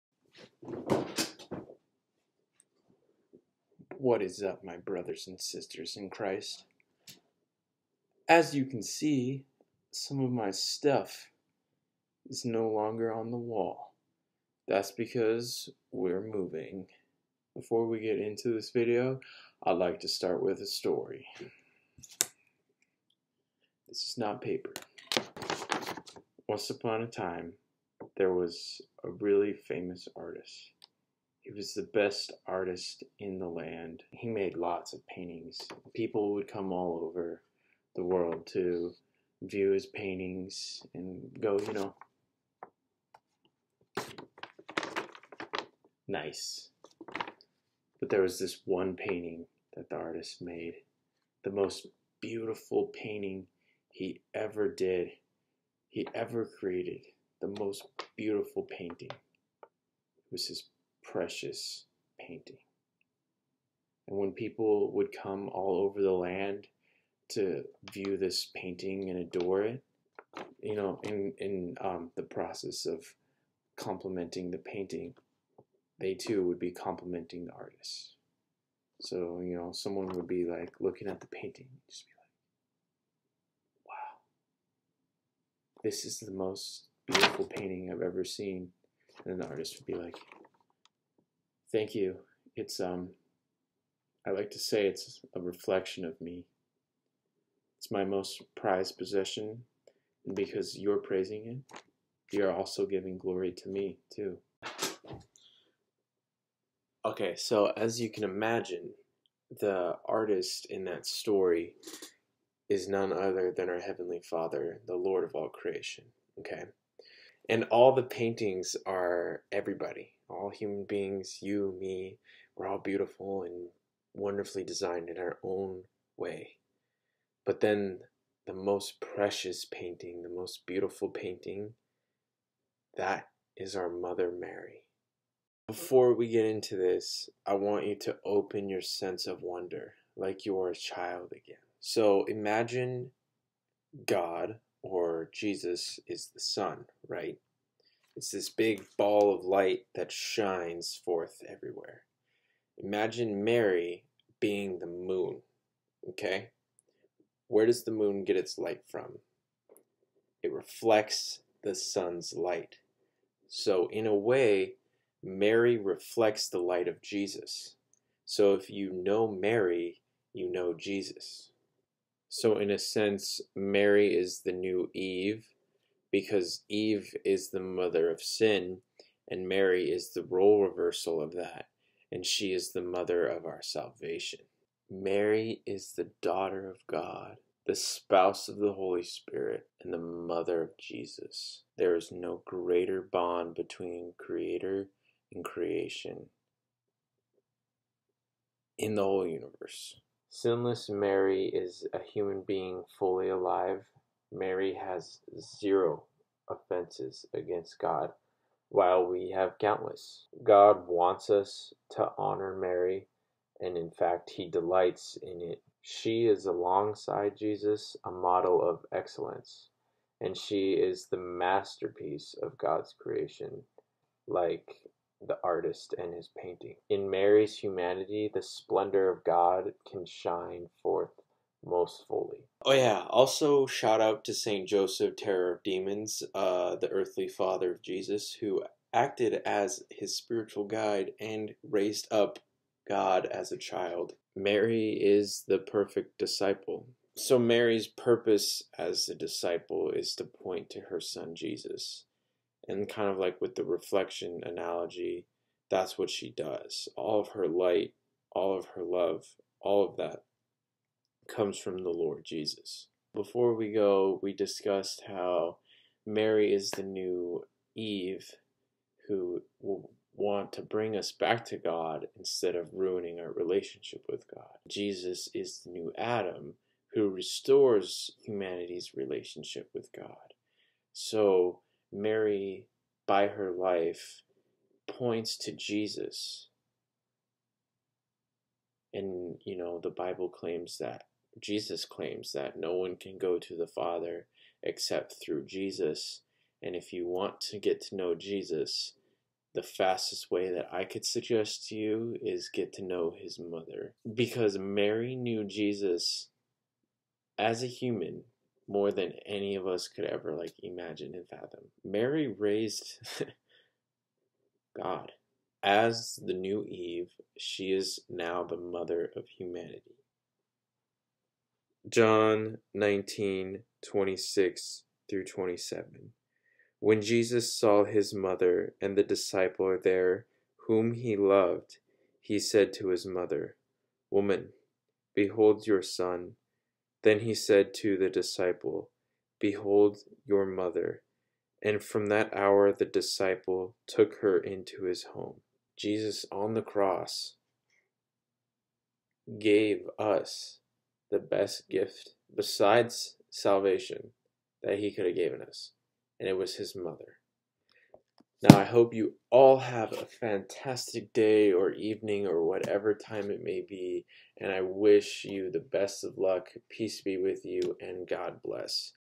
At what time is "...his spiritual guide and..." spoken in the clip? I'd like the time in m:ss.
3:59.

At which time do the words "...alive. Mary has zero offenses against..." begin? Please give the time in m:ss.
3:23.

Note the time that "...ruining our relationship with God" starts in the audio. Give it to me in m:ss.
4:32.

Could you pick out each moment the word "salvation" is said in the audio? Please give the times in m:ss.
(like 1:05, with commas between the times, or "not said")
3:03, 5:53.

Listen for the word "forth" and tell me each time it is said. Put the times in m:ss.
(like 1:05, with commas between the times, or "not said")
2:31, 3:50.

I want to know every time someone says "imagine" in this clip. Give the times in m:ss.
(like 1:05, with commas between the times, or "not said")
1:48, 2:22, 2:32, 5:10.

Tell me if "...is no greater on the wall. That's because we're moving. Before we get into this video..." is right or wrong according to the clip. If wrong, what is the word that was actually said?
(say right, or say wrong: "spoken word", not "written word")
wrong: "longer", not "greater".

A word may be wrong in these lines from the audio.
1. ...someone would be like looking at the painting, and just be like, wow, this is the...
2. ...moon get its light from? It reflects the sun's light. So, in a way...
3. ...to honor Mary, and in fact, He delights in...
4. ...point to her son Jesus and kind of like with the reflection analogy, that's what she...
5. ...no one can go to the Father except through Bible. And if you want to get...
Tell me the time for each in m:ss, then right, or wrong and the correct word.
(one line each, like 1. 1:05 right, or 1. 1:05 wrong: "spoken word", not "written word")
1. 1:19 right
2. 2:37 right
3. 3:31 right
4. 4:10 right
5. 4:52 wrong: "Jesus", not "Bible".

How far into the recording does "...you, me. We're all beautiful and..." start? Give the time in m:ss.
2:01.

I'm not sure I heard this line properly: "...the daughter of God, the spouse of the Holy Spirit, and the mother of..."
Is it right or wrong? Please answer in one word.
right.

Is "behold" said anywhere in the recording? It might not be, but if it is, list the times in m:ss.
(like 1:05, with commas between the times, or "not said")
5:35, 5:39.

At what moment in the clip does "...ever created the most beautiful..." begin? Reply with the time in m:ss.
0:56.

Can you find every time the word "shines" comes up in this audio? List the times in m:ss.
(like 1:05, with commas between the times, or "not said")
2:30, 3:50.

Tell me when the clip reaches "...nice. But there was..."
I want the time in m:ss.
0:46.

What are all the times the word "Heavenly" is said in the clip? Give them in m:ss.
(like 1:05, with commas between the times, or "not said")
1:53.